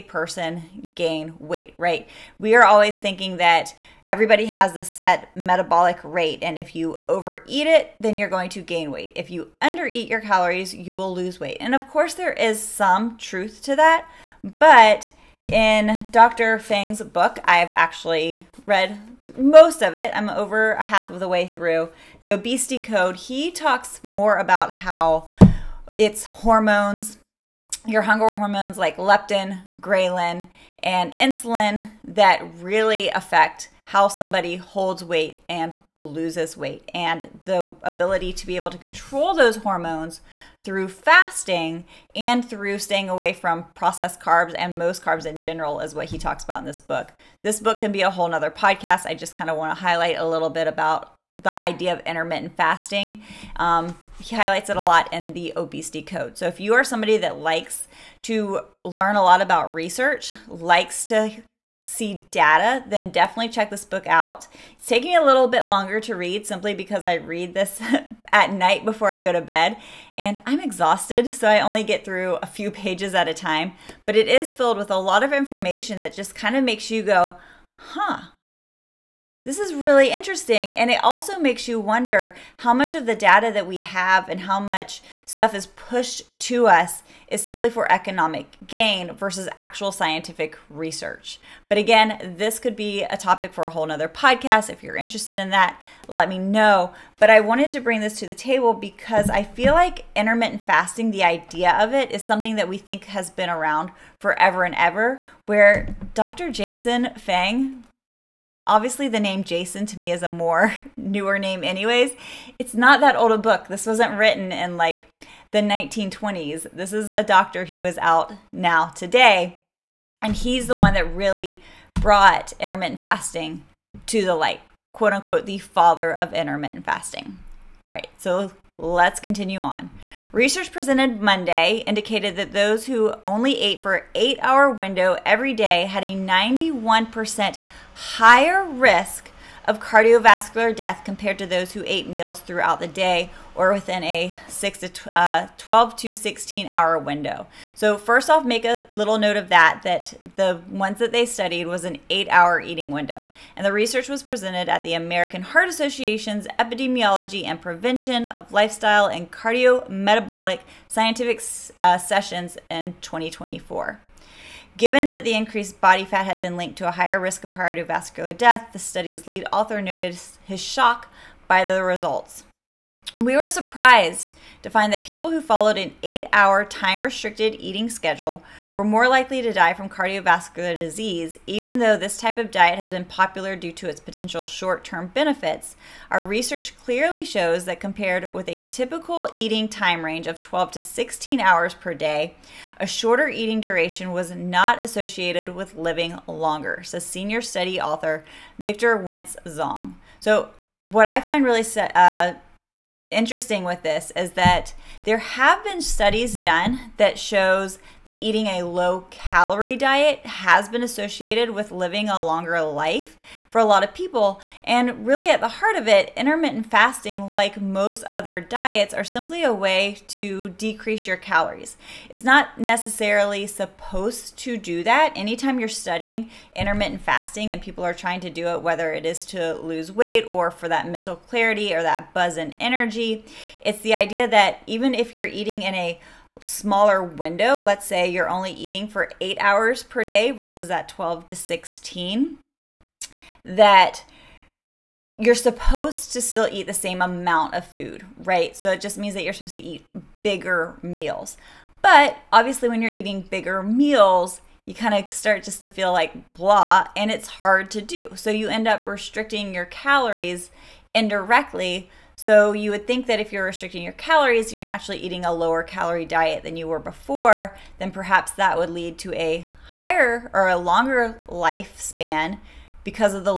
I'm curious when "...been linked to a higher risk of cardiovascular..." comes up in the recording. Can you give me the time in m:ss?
2:46.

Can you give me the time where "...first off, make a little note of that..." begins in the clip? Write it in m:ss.
2:27.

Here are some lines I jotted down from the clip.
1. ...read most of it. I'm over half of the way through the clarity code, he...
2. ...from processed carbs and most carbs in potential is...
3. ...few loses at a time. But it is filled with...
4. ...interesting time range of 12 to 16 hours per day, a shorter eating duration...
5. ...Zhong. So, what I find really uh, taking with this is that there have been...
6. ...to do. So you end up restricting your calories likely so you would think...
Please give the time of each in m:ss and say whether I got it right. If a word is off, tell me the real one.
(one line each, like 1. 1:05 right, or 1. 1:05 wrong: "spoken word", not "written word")
1. 0:18 wrong: "obesity", not "clarity"
2. 0:43 wrong: "general", not "potential"
3. 1:12 wrong: "pages", not "loses"
4. 3:09 wrong: "eating", not "interesting"
5. 3:19 wrong: "interesting", not "taking"
6. 4:17 wrong: "indirectly", not "likely".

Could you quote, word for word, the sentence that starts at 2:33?
And the research was presented at the American Heart Association's Epidemiology and Prevention of Lifestyle and Cardiometabolic Scientific uh, Sessions in 2024.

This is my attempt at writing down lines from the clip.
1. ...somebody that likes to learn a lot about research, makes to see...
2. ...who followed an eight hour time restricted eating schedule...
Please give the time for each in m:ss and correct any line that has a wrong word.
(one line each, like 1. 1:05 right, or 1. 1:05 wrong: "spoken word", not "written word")
1. 0:56 wrong: "likes", not "makes"
2. 2:55 right.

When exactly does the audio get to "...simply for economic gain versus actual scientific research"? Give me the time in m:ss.
1:27.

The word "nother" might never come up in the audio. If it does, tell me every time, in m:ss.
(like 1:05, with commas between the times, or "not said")
0:48, 1:33.